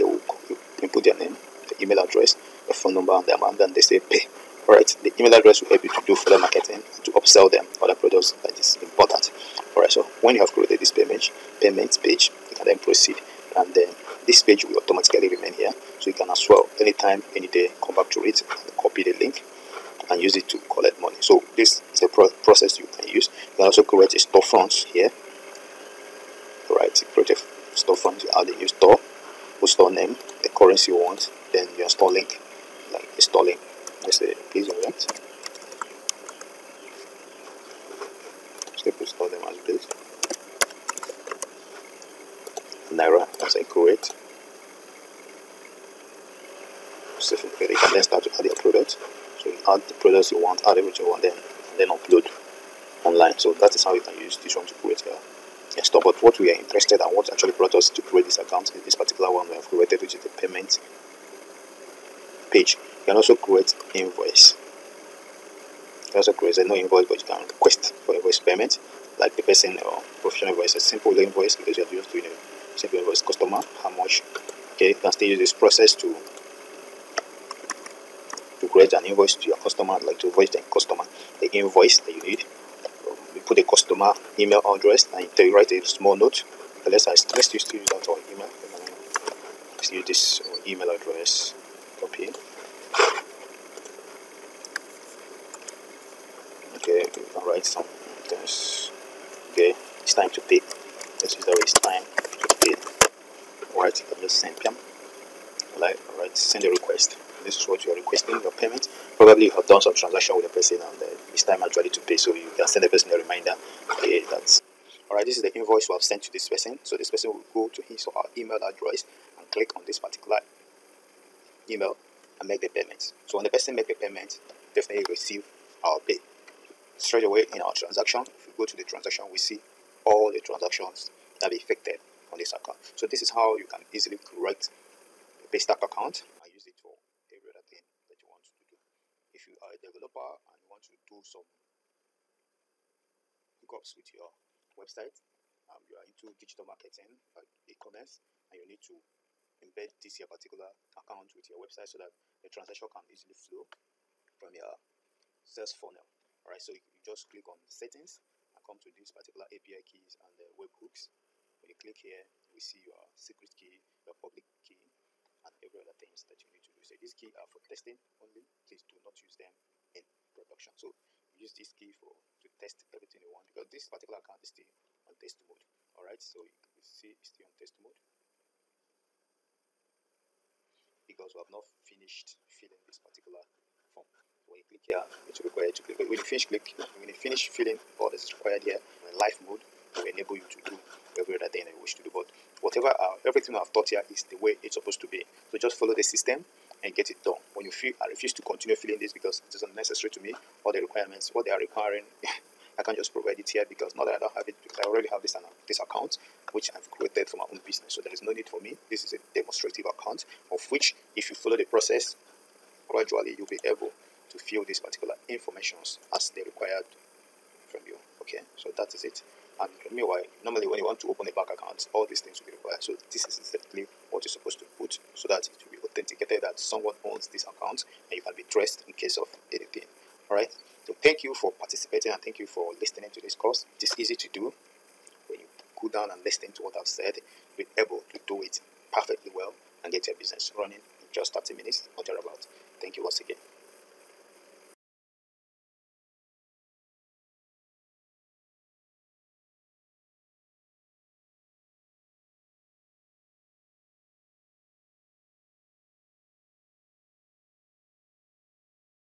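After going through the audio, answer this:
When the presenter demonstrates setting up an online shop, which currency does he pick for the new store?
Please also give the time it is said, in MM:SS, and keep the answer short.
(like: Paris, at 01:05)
naira, at 00:42.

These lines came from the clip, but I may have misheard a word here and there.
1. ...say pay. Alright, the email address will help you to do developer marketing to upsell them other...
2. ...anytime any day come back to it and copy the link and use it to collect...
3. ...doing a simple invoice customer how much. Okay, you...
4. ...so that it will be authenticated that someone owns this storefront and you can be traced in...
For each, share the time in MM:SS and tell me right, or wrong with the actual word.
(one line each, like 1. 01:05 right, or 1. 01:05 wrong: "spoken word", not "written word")
1. 00:03 wrong: "further", not "developer"
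2. 00:16 right
3. 01:12 right
4. 03:45 wrong: "account", not "storefront".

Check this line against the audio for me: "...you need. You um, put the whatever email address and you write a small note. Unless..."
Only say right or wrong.
wrong.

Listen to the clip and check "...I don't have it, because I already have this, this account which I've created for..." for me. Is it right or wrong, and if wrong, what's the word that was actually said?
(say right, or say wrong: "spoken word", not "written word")
right.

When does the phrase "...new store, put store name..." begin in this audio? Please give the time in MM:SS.
00:28.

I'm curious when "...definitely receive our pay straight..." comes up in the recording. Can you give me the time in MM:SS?
02:04.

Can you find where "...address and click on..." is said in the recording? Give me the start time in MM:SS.
01:58.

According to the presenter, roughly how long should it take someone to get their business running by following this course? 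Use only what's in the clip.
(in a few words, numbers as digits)
30 minutes.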